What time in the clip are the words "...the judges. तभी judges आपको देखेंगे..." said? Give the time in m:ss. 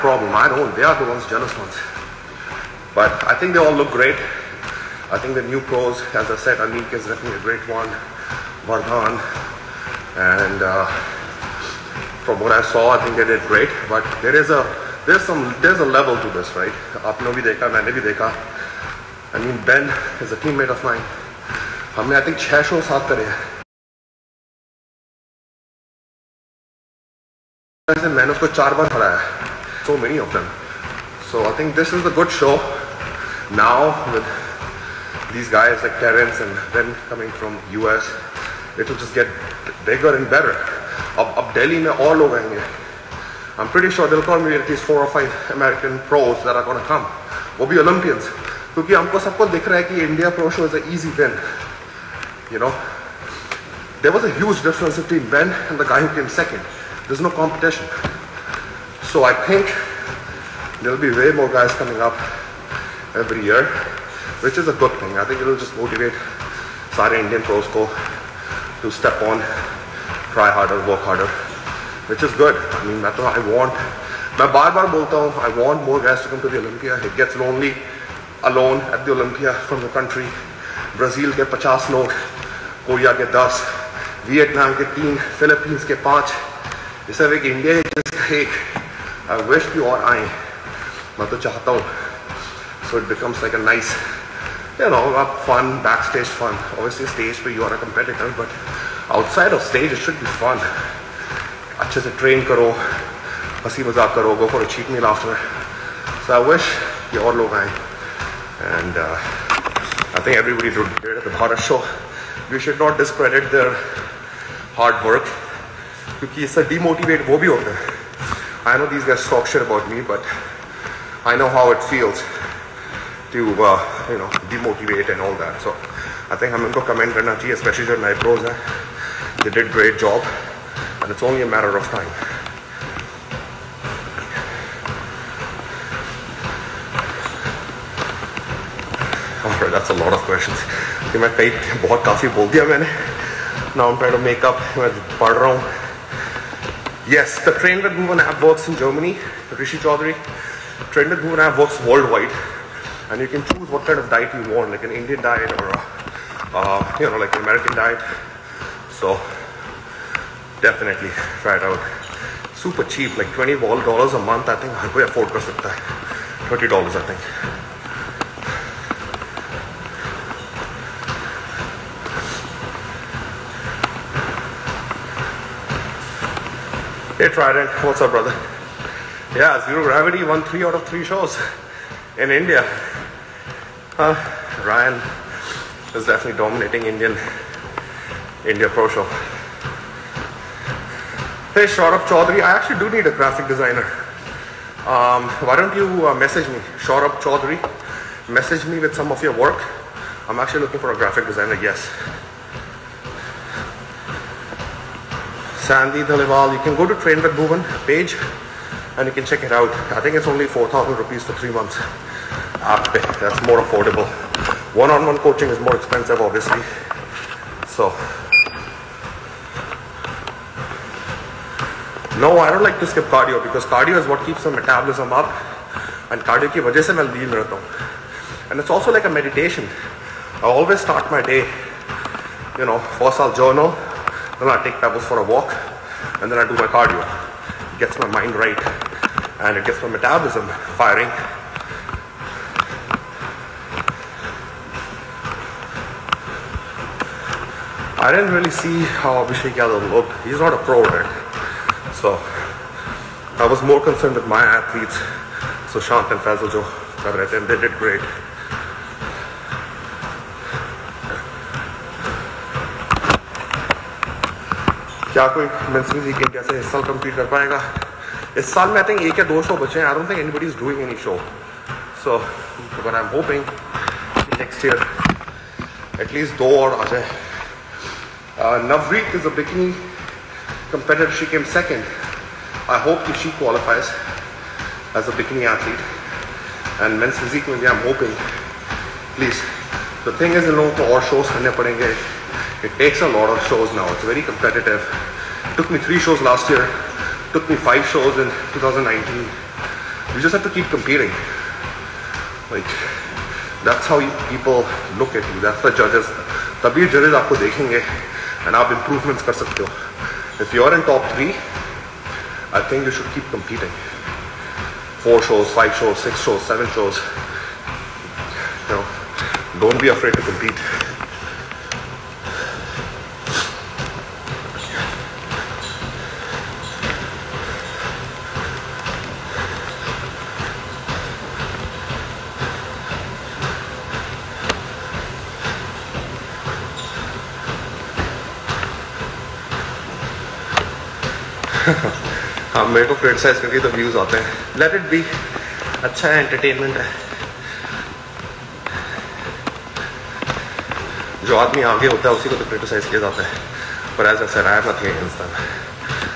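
5:05.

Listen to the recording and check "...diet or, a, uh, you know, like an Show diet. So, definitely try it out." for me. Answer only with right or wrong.
wrong.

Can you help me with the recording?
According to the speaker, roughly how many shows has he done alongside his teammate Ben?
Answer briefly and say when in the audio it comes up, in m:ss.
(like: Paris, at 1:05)
600, at 0:22.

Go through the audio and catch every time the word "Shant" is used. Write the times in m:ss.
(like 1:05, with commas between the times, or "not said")
4:15.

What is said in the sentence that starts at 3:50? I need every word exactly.
I always start my day, you know, for sal journal.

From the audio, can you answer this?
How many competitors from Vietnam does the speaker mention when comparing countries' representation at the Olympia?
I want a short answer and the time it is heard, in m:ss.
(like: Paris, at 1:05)
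3, at 1:24.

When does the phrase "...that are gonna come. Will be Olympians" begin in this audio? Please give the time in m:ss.
0:46.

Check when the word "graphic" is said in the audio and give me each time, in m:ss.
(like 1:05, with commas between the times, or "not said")
3:13, 3:20.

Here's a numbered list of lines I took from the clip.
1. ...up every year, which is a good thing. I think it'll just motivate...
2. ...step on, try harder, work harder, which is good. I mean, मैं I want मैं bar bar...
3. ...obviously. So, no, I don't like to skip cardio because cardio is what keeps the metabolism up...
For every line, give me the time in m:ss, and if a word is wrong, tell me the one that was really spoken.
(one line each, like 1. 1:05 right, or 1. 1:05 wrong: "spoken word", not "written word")
1. 1:02 right
2. 1:08 right
3. 3:36 right.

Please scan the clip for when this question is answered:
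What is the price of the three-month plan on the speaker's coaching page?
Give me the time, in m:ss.
3:30.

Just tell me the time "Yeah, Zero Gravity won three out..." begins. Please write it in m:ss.
2:59.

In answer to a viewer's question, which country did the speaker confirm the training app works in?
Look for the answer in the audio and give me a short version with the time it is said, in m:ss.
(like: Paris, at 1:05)
Germany, at 2:28.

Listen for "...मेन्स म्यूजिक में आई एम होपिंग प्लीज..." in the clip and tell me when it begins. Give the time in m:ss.
4:46.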